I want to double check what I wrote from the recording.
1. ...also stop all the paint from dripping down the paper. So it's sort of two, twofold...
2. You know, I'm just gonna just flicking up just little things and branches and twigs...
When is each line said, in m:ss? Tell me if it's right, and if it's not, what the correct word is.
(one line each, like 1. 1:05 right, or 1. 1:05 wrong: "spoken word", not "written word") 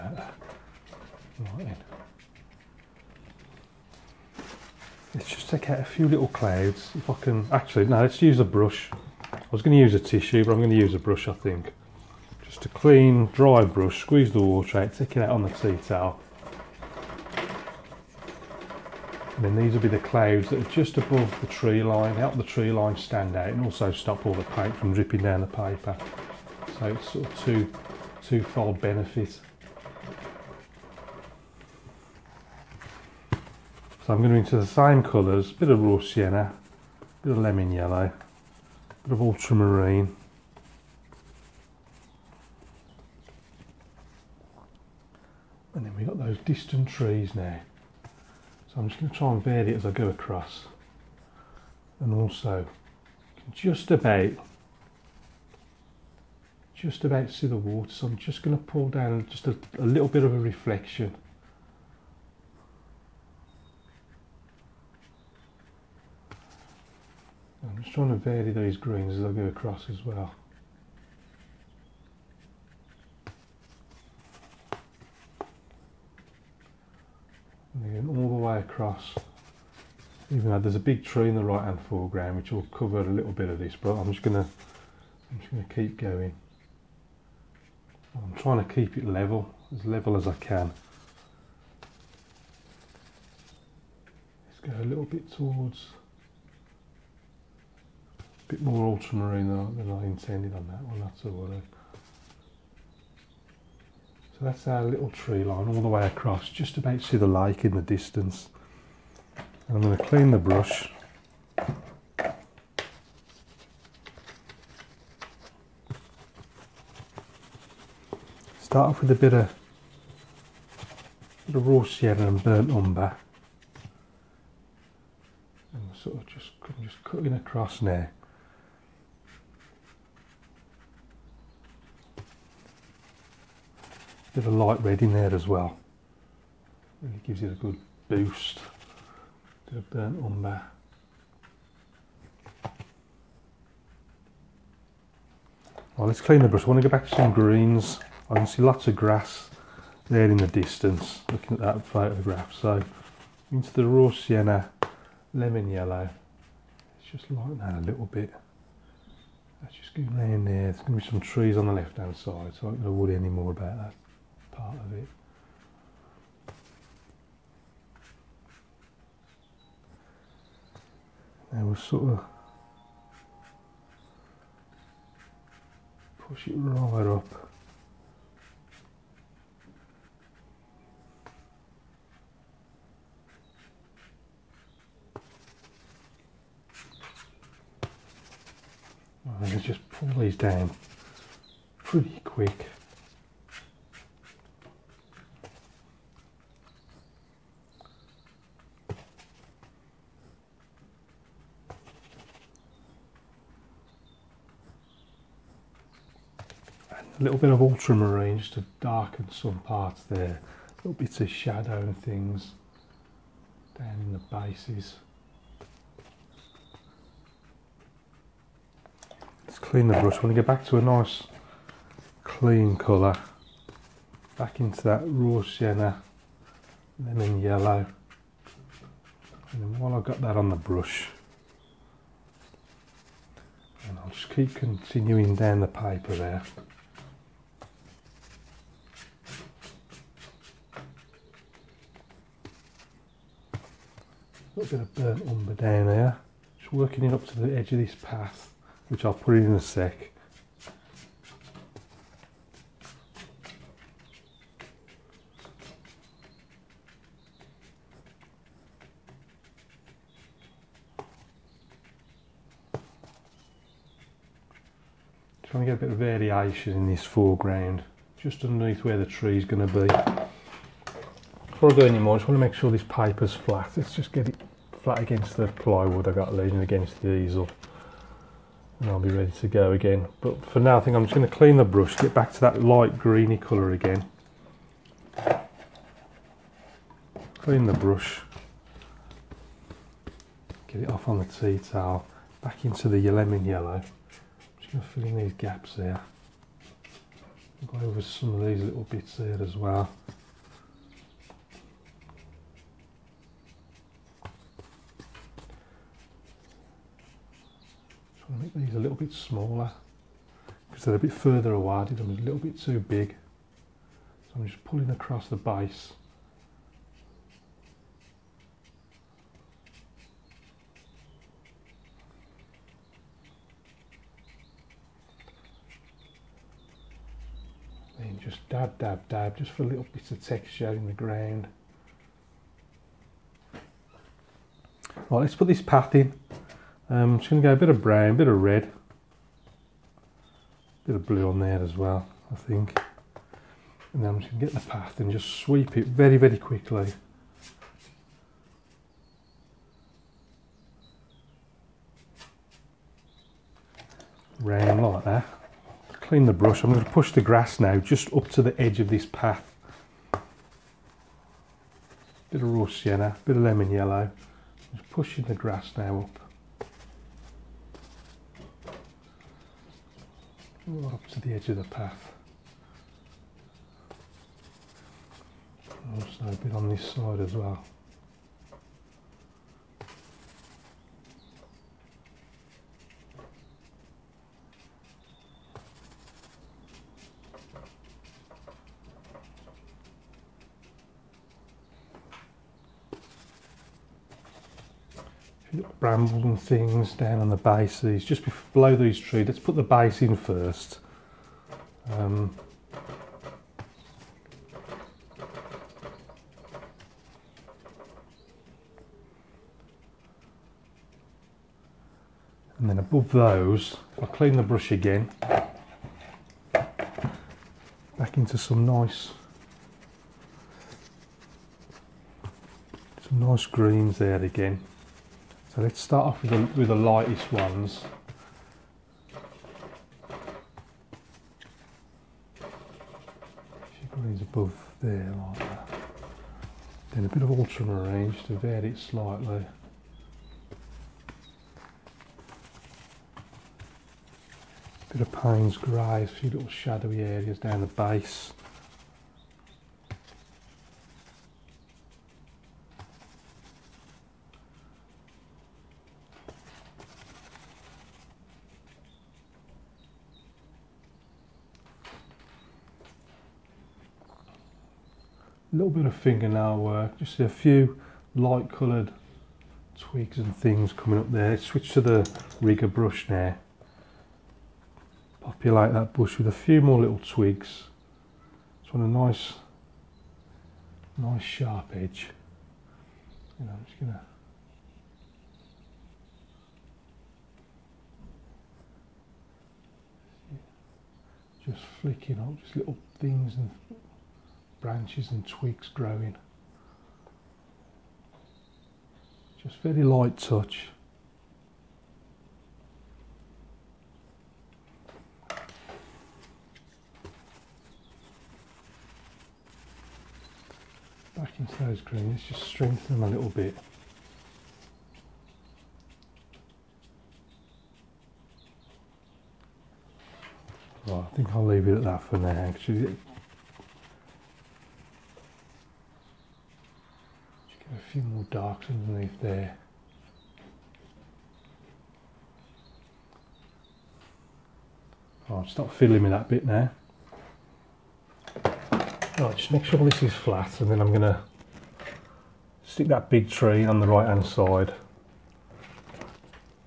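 1. 0:23 right
2. 8:03 right.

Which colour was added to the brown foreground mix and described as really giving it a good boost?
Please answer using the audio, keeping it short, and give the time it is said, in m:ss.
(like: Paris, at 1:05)
light red, at 2:14.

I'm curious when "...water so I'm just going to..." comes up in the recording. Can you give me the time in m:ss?
0:57.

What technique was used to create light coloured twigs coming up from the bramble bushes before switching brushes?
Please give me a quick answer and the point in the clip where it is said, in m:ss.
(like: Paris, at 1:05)
fingernail work, at 7:45.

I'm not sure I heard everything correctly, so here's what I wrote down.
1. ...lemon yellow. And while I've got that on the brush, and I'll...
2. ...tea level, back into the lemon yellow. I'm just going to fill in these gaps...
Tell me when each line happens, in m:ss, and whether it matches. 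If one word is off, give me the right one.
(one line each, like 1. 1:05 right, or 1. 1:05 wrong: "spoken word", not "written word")
1. 3:47 right
2. 4:51 wrong: "towel", not "level".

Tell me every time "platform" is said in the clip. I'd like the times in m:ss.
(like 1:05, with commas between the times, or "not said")
not said.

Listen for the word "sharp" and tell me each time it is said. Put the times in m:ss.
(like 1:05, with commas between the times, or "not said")
8:01.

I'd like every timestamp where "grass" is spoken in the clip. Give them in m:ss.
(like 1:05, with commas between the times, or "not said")
2:28, 5:57, 6:05.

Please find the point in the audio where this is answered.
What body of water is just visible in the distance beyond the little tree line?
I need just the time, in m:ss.
1:47.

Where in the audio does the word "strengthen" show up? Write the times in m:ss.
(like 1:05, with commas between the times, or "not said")
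8:32.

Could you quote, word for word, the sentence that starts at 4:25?
Trying to get a bit of variation in this foreground, just underneath where the tree is going to be.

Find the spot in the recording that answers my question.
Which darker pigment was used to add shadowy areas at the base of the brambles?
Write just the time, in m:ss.
7:25.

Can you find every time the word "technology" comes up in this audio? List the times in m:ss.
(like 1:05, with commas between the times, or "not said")
not said.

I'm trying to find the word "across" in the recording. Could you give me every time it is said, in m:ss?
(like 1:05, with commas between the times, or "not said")
0:50, 1:09, 1:18, 1:46, 2:07, 5:14.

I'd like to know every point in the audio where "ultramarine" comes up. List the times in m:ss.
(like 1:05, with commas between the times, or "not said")
0:39, 1:38, 3:27, 7:17.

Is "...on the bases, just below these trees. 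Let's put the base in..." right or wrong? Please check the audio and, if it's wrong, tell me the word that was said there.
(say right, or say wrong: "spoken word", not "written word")
right.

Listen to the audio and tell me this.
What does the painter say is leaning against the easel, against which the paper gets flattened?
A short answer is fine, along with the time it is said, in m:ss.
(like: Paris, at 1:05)
plywood, at 4:35.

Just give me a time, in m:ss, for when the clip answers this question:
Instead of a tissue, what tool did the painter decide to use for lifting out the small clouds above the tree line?
0:12.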